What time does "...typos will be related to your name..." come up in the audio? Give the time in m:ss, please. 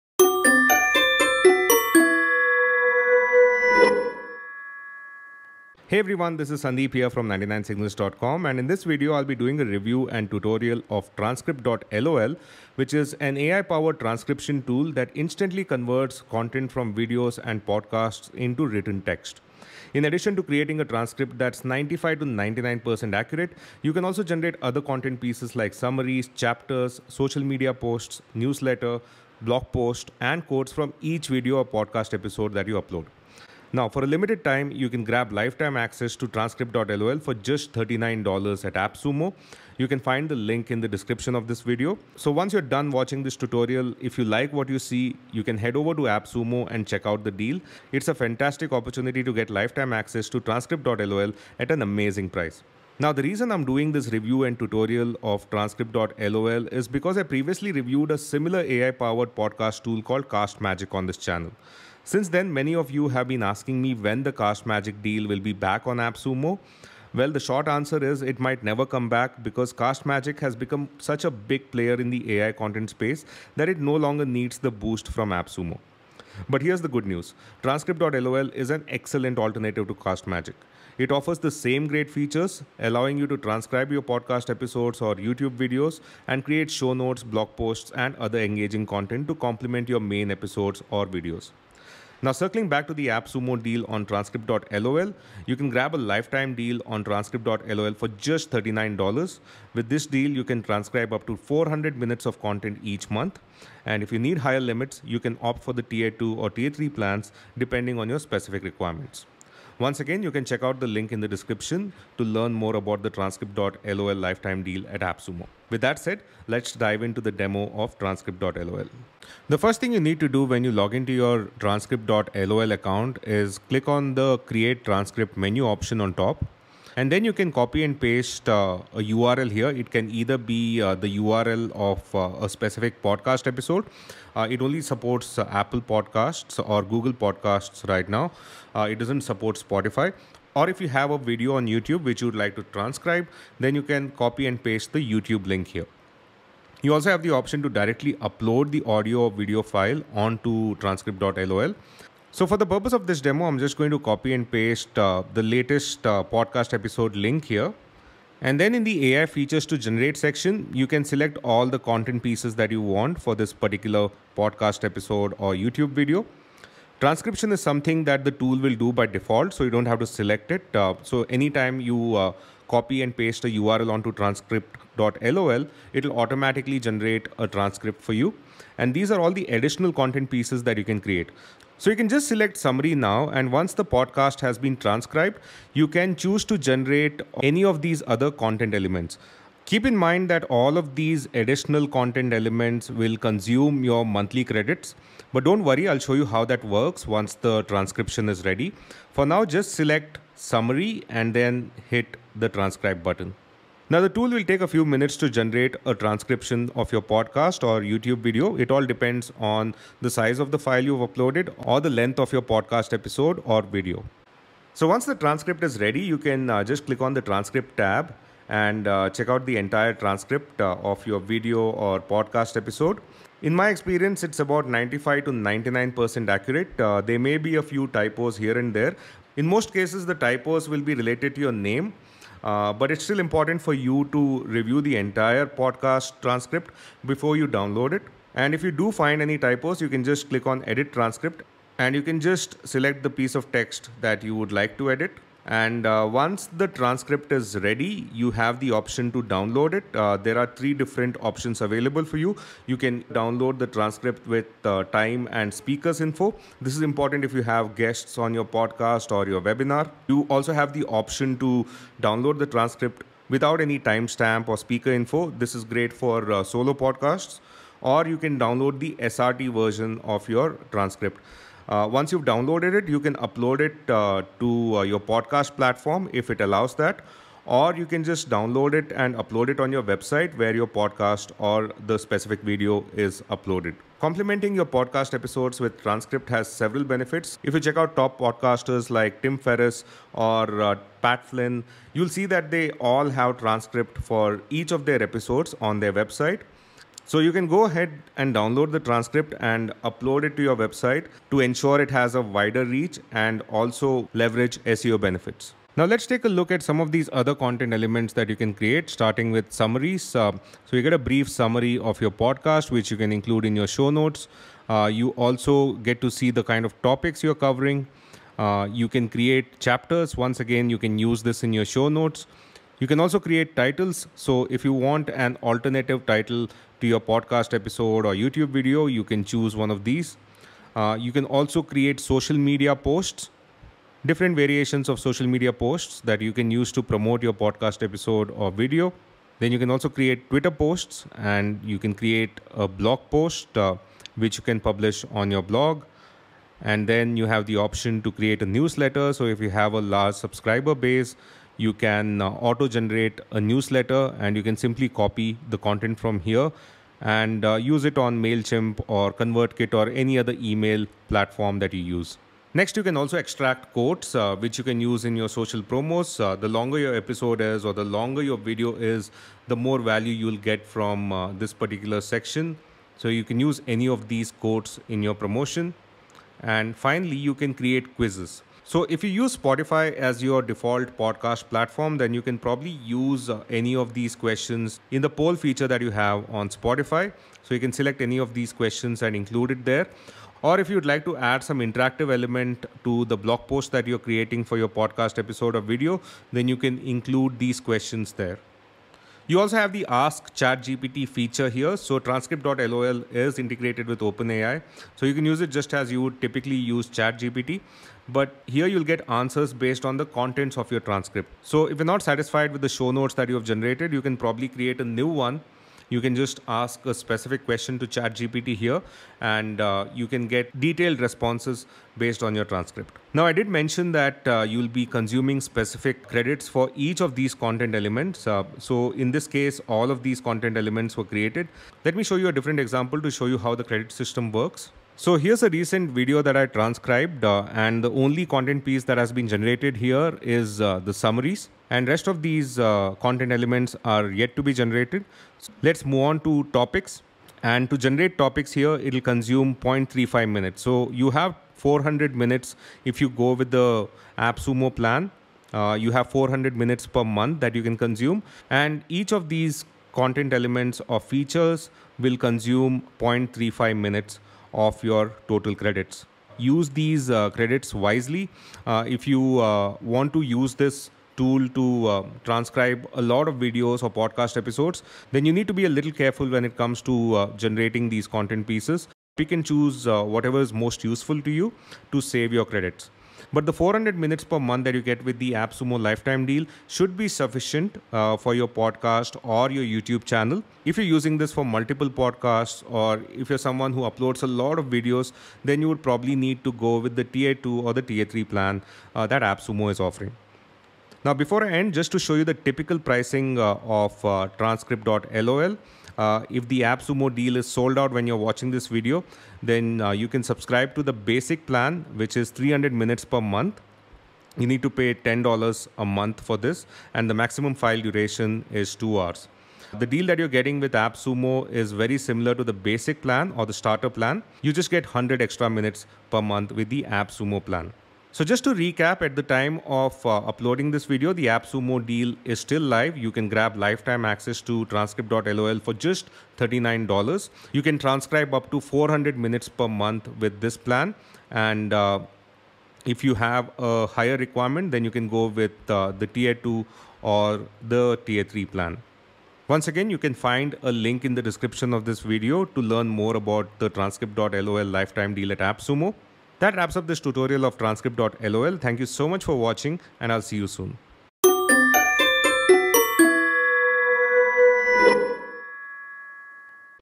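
3:50.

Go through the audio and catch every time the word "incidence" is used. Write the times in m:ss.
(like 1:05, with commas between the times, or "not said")
not said.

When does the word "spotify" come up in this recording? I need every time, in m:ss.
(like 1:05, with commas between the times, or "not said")
2:19, 6:19, 6:26.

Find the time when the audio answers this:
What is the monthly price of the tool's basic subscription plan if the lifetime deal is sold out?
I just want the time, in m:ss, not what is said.
8:34.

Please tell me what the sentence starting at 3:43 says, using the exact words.
In my experience, it's about 95 to 99% accurate.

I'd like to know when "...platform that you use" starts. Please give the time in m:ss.
6:01.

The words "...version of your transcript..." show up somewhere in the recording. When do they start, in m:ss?
4:29.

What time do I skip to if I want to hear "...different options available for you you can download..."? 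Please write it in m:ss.
4:10.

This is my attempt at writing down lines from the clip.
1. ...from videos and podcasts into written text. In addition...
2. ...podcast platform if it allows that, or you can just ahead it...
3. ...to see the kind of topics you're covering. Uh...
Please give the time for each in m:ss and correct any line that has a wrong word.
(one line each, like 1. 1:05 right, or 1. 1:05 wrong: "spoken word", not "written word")
1. 0:16 right
2. 4:34 wrong: "download", not "ahead"
3. 5:15 right.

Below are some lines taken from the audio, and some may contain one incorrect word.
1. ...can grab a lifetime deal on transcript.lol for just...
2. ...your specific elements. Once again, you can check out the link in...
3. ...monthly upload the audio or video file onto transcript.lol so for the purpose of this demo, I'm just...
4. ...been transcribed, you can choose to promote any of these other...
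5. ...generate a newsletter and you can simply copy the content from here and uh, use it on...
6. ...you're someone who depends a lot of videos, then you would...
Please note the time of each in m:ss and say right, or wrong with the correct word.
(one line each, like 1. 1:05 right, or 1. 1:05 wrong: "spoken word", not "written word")
1. 1:35 right
2. 1:48 wrong: "requirements", not "elements"
3. 2:27 wrong: "directly", not "monthly"
4. 3:04 wrong: "generate", not "promote"
5. 5:52 right
6. 8:13 wrong: "uploads", not "depends".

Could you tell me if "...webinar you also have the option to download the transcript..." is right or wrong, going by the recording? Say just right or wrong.
right.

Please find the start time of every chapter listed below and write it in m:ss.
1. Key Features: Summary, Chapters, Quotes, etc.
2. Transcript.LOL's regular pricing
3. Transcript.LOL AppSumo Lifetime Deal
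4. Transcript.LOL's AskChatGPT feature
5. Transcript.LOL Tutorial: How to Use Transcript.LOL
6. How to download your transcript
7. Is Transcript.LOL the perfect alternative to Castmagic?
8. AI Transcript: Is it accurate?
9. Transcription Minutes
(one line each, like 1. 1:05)
1. 5:05
2. 8:20
3. 0:33
4. 6:38
5. 1:59
6. 4:05
7. 0:52
8. 3:34
9. 7:02.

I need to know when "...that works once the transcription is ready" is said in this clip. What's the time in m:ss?
3:16.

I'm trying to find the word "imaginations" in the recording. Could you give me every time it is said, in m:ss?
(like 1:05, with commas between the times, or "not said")
not said.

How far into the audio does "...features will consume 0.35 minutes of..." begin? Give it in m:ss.
7:40.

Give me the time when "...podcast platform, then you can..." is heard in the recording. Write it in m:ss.
6:20.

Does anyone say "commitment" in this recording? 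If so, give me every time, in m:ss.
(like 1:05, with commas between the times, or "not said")
not said.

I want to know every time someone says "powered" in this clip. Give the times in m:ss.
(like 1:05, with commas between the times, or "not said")
0:13, 0:58.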